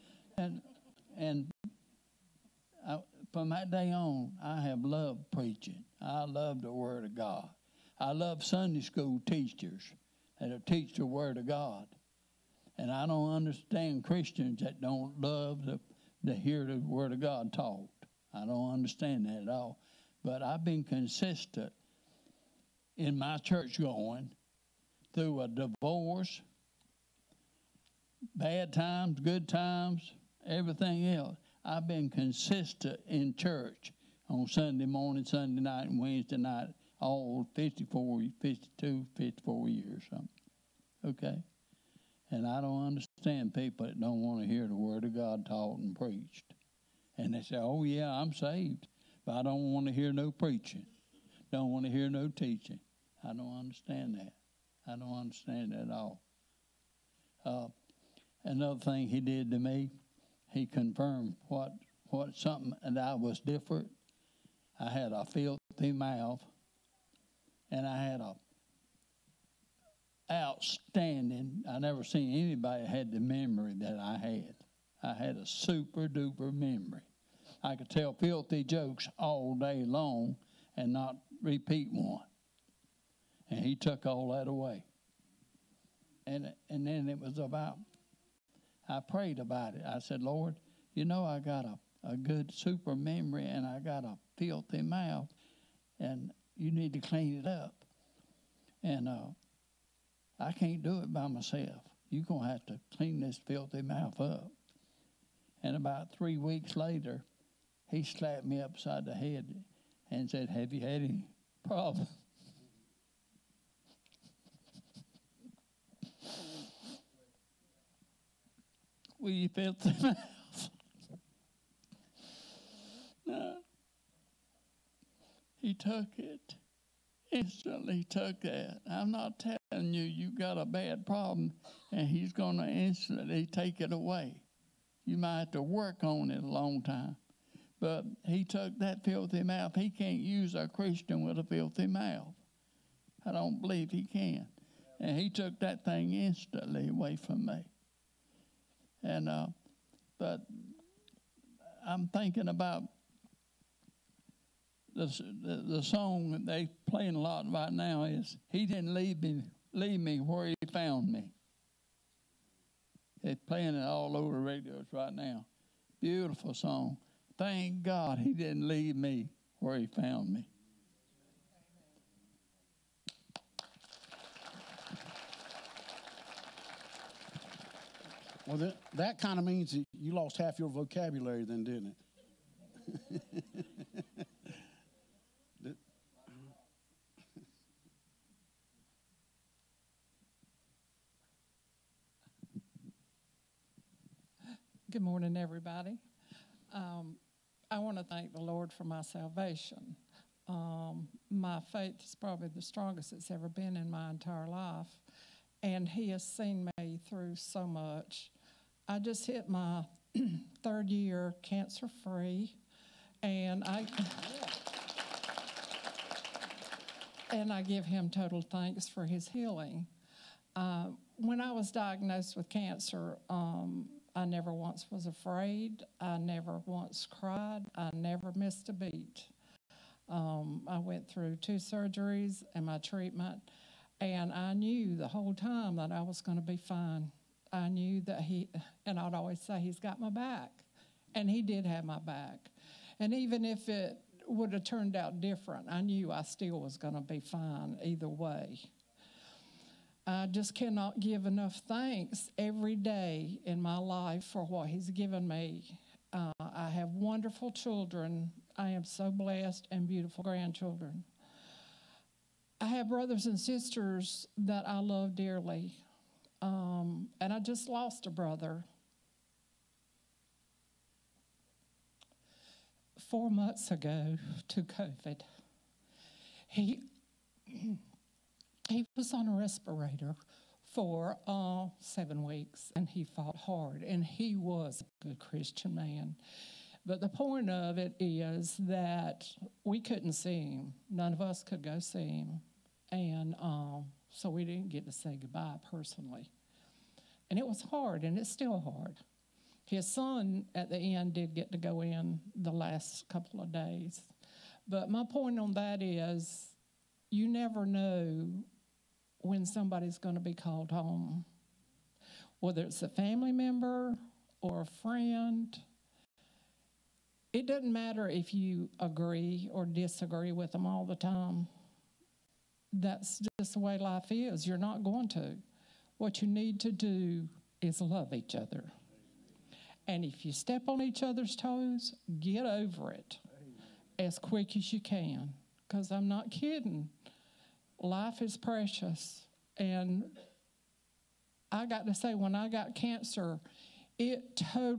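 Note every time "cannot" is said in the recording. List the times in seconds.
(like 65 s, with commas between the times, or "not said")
250 s.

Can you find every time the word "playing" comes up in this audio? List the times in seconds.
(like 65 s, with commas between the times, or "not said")
156 s, 163 s.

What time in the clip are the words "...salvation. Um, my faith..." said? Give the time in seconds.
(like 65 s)
199 s.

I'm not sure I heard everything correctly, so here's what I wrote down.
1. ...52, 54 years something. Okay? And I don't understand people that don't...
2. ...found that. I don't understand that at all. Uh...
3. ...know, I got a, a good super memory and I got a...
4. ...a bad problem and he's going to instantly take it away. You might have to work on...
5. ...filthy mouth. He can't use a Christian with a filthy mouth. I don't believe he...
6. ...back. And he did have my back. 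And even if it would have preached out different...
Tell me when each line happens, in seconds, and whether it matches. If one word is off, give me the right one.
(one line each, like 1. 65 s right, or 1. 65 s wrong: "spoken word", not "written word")
1. 38 s right
2. 53 s wrong: "understand", not "found"
3. 91 s right
4. 130 s right
5. 139 s right
6. 240 s wrong: "turned", not "preached".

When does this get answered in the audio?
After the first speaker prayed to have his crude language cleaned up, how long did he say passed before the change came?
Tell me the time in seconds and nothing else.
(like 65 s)
105 s.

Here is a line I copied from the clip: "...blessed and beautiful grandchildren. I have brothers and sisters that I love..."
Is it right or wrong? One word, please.
right.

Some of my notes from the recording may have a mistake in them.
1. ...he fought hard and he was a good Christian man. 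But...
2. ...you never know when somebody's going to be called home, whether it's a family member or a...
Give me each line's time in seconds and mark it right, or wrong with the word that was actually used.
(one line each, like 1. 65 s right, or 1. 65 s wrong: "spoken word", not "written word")
1. 282 s right
2. 307 s right.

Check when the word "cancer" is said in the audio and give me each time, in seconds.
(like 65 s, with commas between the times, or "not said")
211 s, 222 s, 342 s.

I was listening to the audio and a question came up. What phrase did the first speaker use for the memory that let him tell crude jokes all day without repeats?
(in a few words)
super duper memory.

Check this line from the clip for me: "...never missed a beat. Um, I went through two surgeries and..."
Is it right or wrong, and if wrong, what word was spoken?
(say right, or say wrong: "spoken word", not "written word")
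right.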